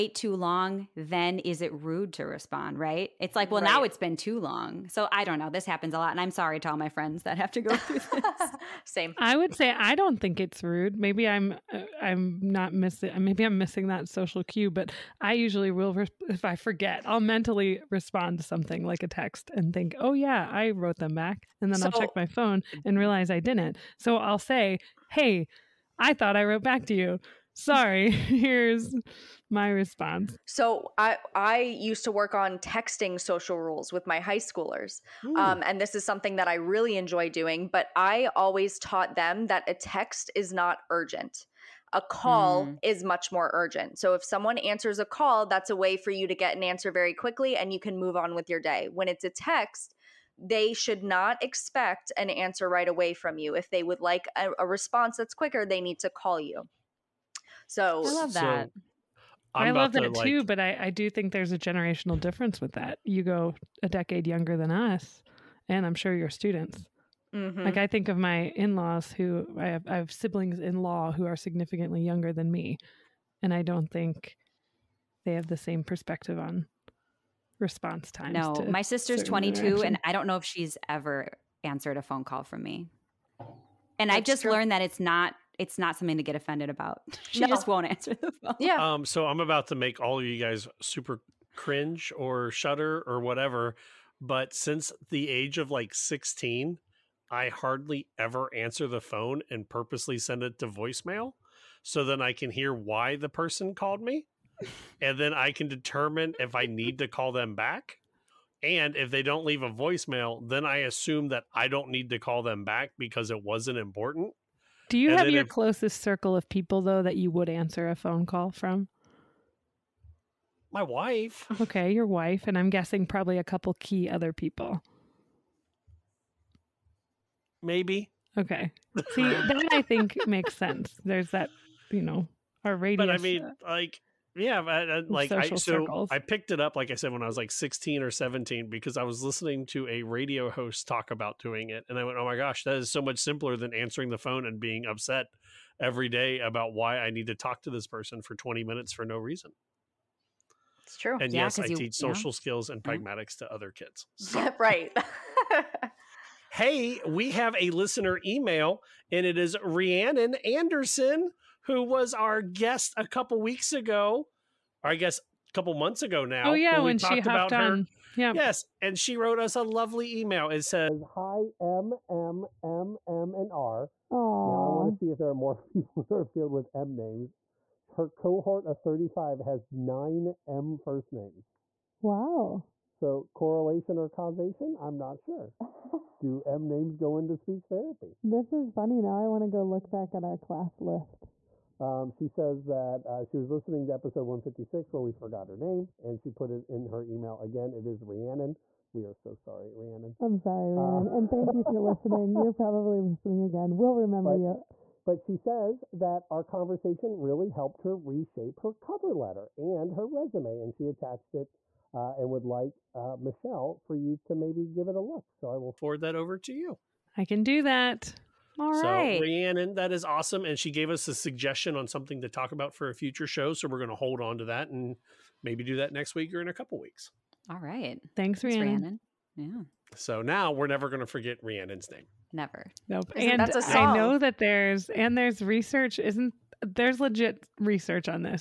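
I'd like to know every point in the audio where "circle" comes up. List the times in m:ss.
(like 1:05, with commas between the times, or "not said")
1:56, 2:15.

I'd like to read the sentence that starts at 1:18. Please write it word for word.
No, my sister's 22, and I don't know if she's ever answered a phone call from me.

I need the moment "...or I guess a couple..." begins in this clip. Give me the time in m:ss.
2:44.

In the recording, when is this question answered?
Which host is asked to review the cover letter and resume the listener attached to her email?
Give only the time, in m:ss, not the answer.
3:33.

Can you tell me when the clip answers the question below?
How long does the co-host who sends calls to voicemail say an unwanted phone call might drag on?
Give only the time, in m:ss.
2:28.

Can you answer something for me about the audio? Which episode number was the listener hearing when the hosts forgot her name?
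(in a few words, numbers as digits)
156.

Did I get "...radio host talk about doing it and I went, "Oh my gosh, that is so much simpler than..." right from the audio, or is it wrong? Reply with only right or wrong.
right.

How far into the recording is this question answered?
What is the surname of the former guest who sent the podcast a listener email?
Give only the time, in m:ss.
2:40.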